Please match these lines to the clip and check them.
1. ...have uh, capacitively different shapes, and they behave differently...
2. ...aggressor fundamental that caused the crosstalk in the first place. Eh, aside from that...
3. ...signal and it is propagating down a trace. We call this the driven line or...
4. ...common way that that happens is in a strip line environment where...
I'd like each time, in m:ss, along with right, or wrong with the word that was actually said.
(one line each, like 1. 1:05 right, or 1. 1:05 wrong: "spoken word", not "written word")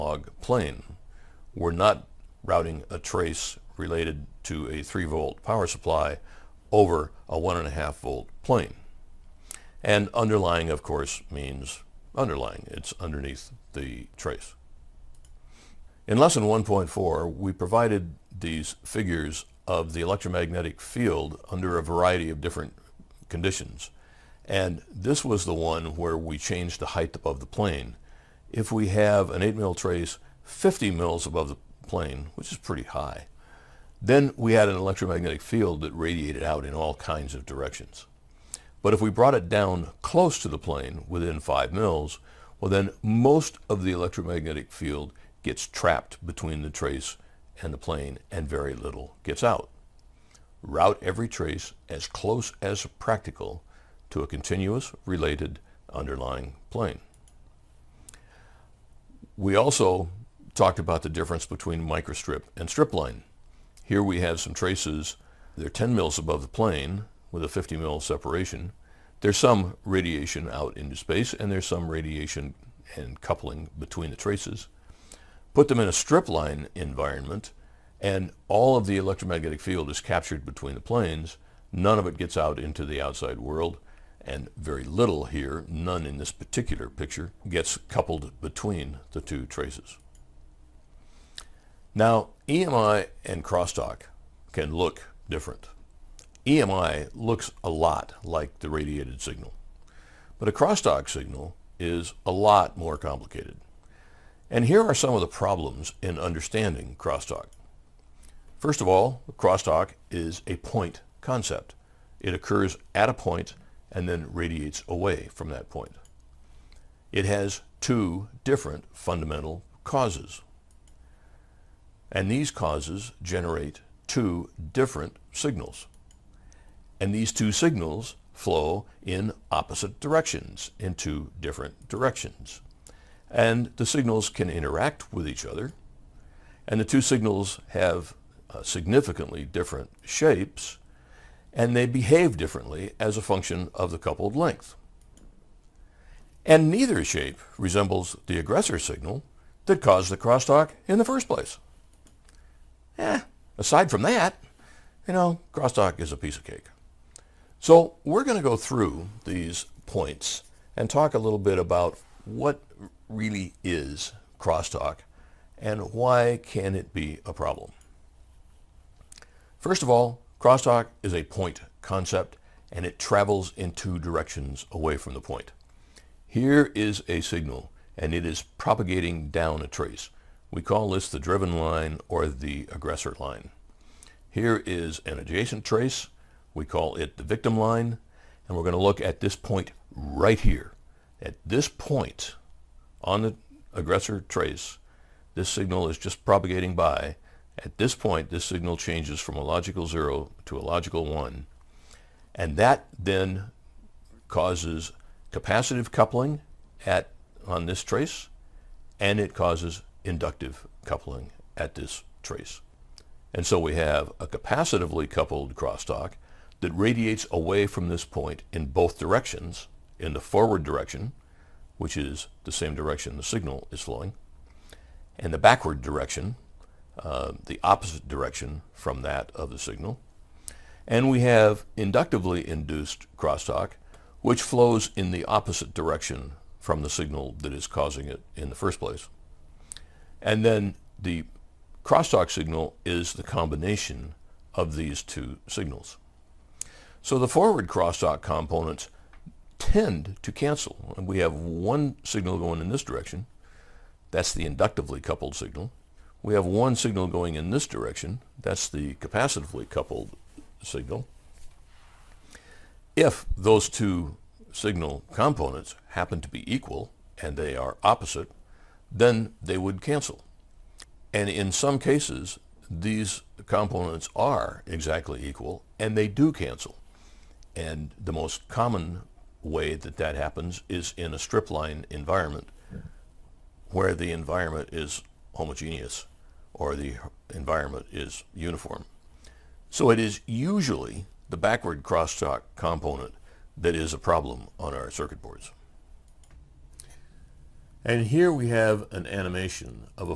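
1. 2:17 wrong: "significantly", not "capacitively"
2. 2:28 wrong: "signal", not "fundamental"
3. 2:57 right
4. 4:38 right.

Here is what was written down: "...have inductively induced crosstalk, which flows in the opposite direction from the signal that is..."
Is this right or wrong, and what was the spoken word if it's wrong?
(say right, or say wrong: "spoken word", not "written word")
right.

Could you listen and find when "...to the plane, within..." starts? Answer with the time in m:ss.
0:40.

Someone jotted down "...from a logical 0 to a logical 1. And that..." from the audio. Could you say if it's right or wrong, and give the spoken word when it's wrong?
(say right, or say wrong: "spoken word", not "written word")
right.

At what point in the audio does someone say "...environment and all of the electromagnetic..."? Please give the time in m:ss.
1:16.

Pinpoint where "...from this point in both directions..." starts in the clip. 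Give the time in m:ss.
3:37.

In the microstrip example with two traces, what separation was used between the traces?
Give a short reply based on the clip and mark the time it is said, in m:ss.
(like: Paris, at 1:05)
50 mils, at 1:07.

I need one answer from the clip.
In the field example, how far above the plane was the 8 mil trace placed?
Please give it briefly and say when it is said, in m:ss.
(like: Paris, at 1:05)
50 mils, at 0:30.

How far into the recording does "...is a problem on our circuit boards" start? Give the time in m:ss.
4:53.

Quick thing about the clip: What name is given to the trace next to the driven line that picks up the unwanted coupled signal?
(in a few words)
victim line.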